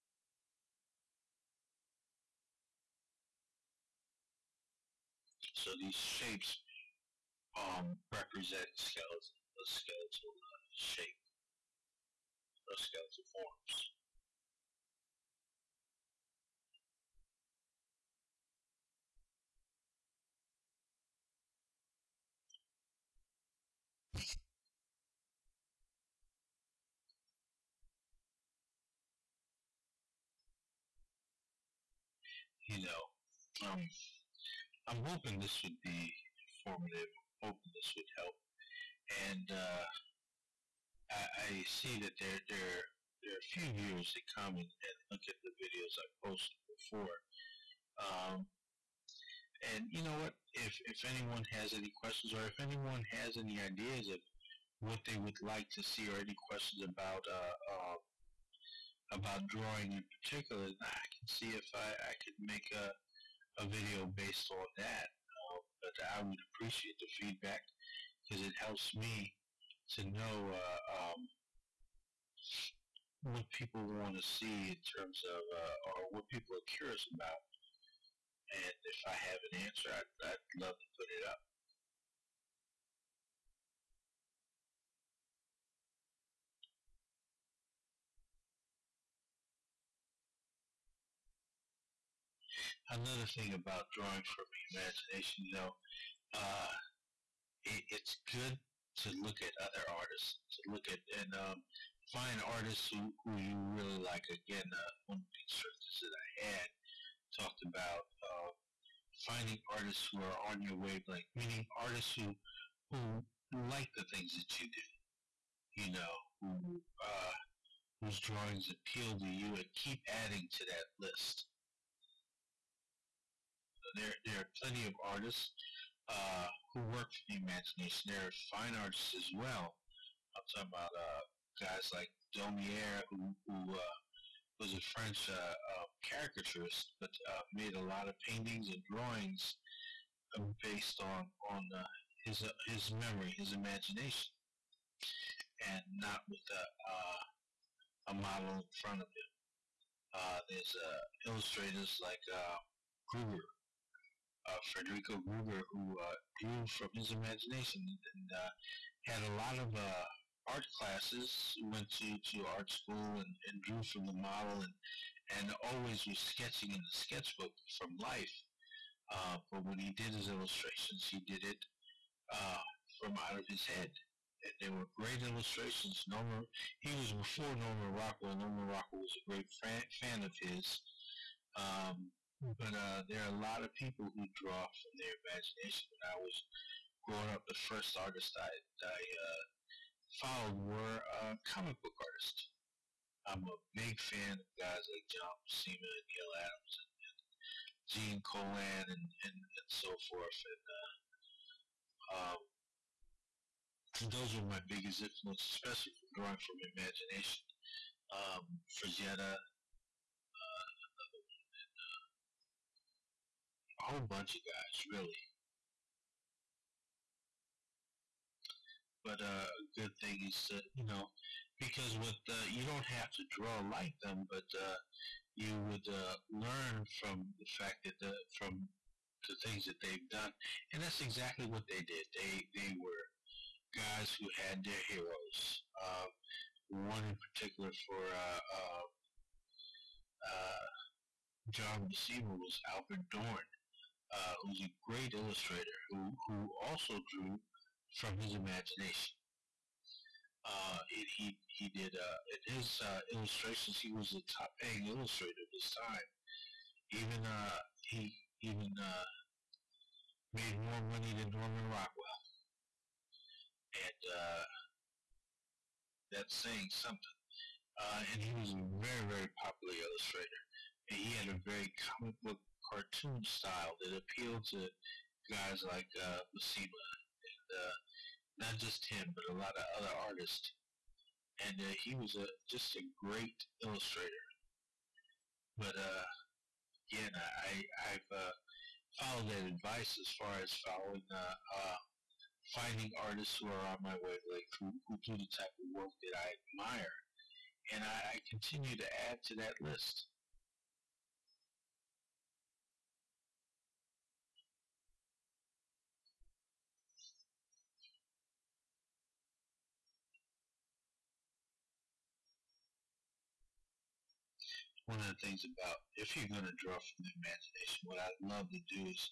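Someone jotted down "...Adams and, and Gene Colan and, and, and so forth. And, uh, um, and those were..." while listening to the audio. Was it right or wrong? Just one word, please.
right.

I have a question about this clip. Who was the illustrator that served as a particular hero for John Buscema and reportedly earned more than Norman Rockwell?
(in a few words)
Albert Dorne.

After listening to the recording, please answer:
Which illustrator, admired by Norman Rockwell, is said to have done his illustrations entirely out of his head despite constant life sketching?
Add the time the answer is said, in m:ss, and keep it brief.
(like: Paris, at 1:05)
Federico Gruger, at 2:34.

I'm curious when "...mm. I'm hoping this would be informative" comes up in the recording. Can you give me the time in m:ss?
0:33.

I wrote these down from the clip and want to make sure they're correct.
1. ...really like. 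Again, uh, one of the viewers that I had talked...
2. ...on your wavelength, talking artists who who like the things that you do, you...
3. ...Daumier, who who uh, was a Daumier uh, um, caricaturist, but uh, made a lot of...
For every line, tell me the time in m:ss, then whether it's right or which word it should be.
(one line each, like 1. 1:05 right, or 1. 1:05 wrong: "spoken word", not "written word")
1. 1:43 wrong: "instructors", not "viewers"
2. 1:50 wrong: "meaning", not "talking"
3. 2:12 wrong: "French", not "Daumier".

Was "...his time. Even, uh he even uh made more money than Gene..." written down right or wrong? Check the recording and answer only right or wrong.
wrong.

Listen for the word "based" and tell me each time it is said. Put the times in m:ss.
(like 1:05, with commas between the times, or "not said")
1:04, 2:20.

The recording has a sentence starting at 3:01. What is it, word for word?
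Um, but uh, there are a lot of people who draw from their imagination.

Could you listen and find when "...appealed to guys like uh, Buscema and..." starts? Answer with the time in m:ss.
4:33.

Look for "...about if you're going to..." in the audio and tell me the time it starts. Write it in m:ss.
5:15.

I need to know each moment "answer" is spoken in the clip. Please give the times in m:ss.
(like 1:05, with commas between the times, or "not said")
1:19.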